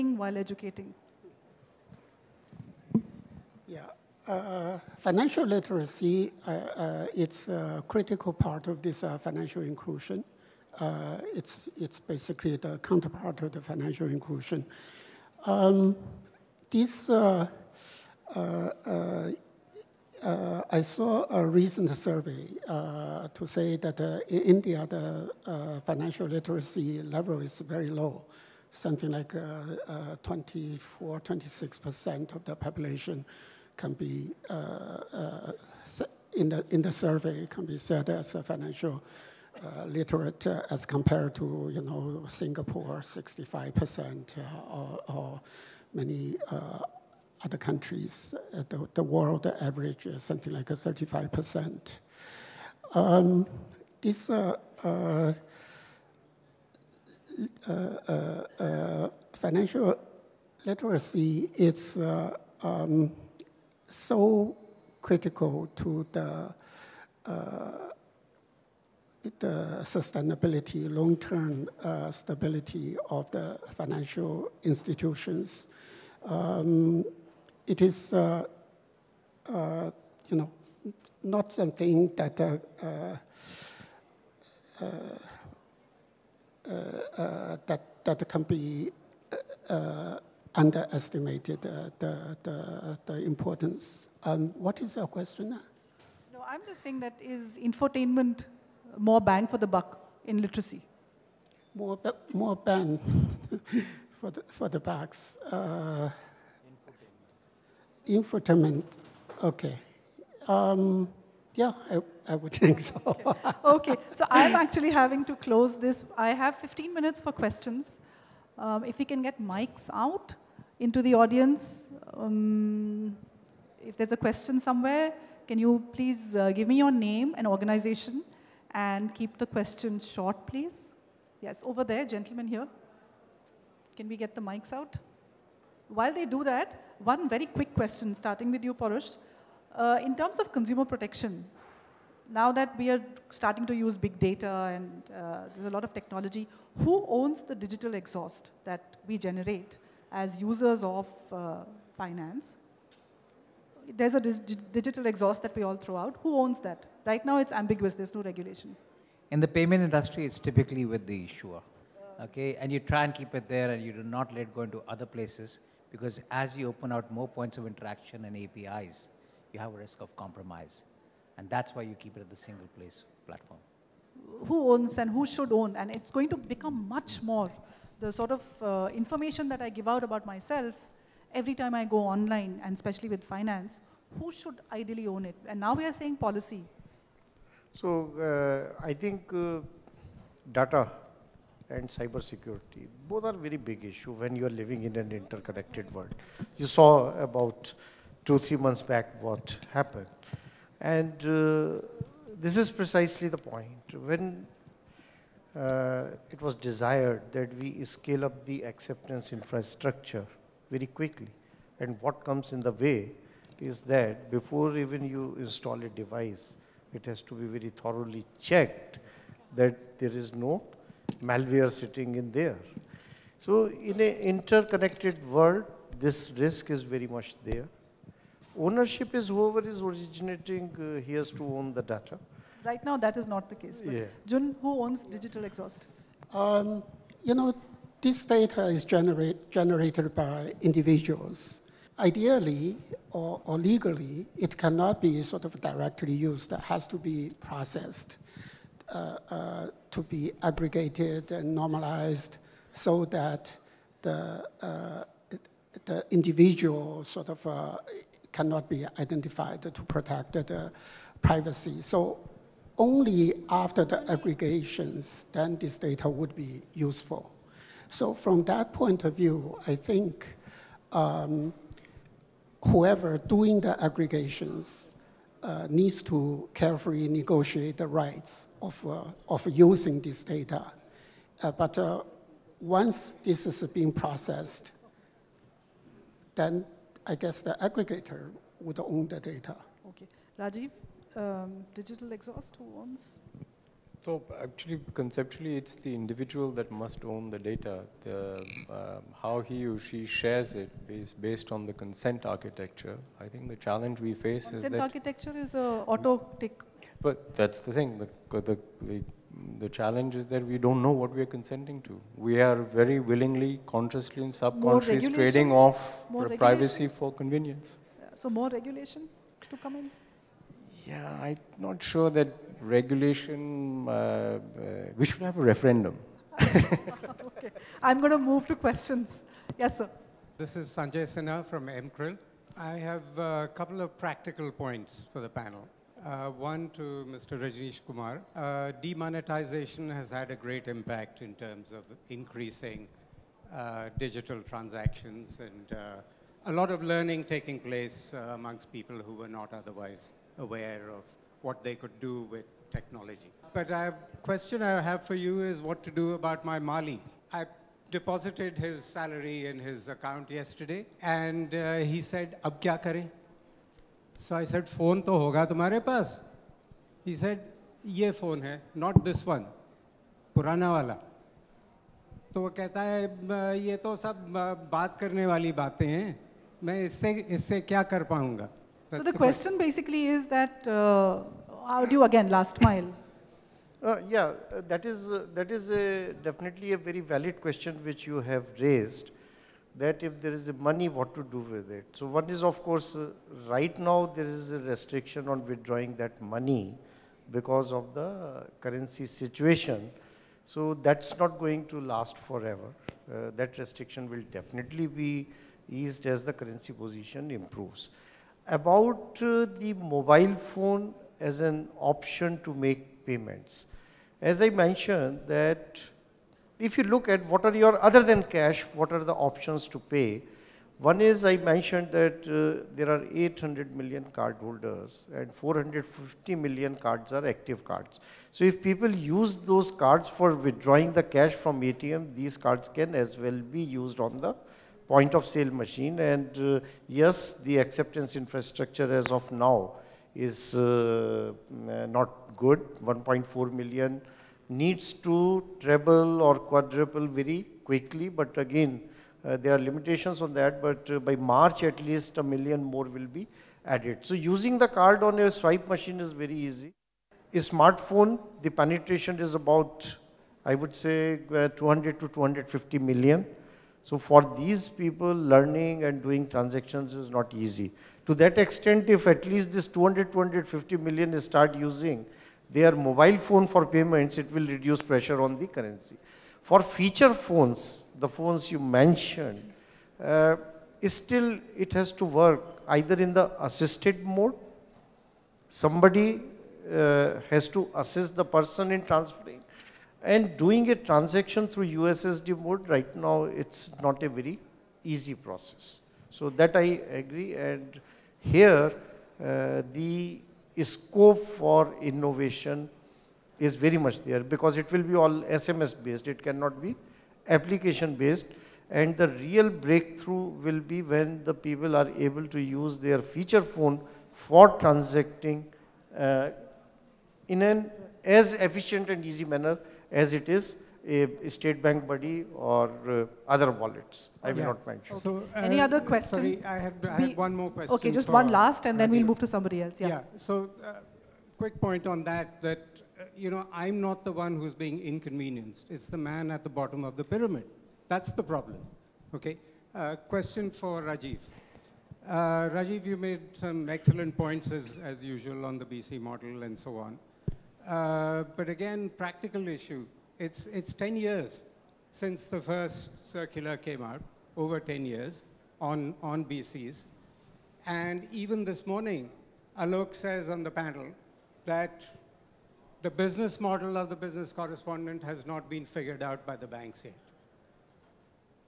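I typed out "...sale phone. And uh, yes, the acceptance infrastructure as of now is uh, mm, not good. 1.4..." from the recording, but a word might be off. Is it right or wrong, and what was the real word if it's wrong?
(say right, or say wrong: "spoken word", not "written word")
wrong: "machine", not "phone".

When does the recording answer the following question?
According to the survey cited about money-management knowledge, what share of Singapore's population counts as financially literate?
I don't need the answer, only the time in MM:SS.
00:43.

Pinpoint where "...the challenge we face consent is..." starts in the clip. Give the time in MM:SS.
05:03.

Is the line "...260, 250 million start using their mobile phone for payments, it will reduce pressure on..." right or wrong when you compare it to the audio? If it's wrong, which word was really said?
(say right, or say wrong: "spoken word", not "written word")
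wrong: "200", not "260".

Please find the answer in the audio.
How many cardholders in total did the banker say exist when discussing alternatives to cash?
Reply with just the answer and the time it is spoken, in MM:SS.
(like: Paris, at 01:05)
800 million, at 07:03.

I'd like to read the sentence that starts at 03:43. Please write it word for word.
So in an interconnected world, this risk is very much there.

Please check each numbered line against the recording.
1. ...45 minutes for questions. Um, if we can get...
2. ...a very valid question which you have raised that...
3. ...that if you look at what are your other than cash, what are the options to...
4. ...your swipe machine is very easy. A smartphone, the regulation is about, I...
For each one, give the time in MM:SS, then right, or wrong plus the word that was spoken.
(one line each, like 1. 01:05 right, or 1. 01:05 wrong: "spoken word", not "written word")
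1. 01:56 wrong: "15", not "45"
2. 06:26 right
3. 06:55 right
4. 07:35 wrong: "penetration", not "regulation".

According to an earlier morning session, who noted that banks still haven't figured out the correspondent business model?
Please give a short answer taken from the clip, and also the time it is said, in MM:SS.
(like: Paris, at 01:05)
Alok, at 09:19.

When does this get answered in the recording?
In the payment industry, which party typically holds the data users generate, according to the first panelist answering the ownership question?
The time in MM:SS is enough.
02:40.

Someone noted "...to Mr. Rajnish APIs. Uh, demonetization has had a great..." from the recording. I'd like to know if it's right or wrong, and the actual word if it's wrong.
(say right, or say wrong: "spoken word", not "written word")
wrong: "Kumar", not "APIs".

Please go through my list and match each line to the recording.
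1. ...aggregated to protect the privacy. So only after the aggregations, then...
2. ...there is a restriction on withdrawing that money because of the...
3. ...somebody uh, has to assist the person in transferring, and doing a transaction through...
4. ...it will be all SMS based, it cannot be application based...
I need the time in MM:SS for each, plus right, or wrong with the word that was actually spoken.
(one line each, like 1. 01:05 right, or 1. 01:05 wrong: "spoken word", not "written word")
1. 04:18 wrong: "identified", not "aggregated"
2. 06:34 right
3. 08:05 right
4. 08:24 right.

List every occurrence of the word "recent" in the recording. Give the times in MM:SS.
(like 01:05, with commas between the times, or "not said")
00:21.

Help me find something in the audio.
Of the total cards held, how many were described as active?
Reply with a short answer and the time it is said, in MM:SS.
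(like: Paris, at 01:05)
450 million, at 07:05.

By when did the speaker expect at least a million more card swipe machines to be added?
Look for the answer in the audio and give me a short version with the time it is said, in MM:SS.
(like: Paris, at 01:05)
March, at 07:30.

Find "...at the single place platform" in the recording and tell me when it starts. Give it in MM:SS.
02:52.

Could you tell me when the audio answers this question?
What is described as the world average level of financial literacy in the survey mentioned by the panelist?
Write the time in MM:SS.
00:50.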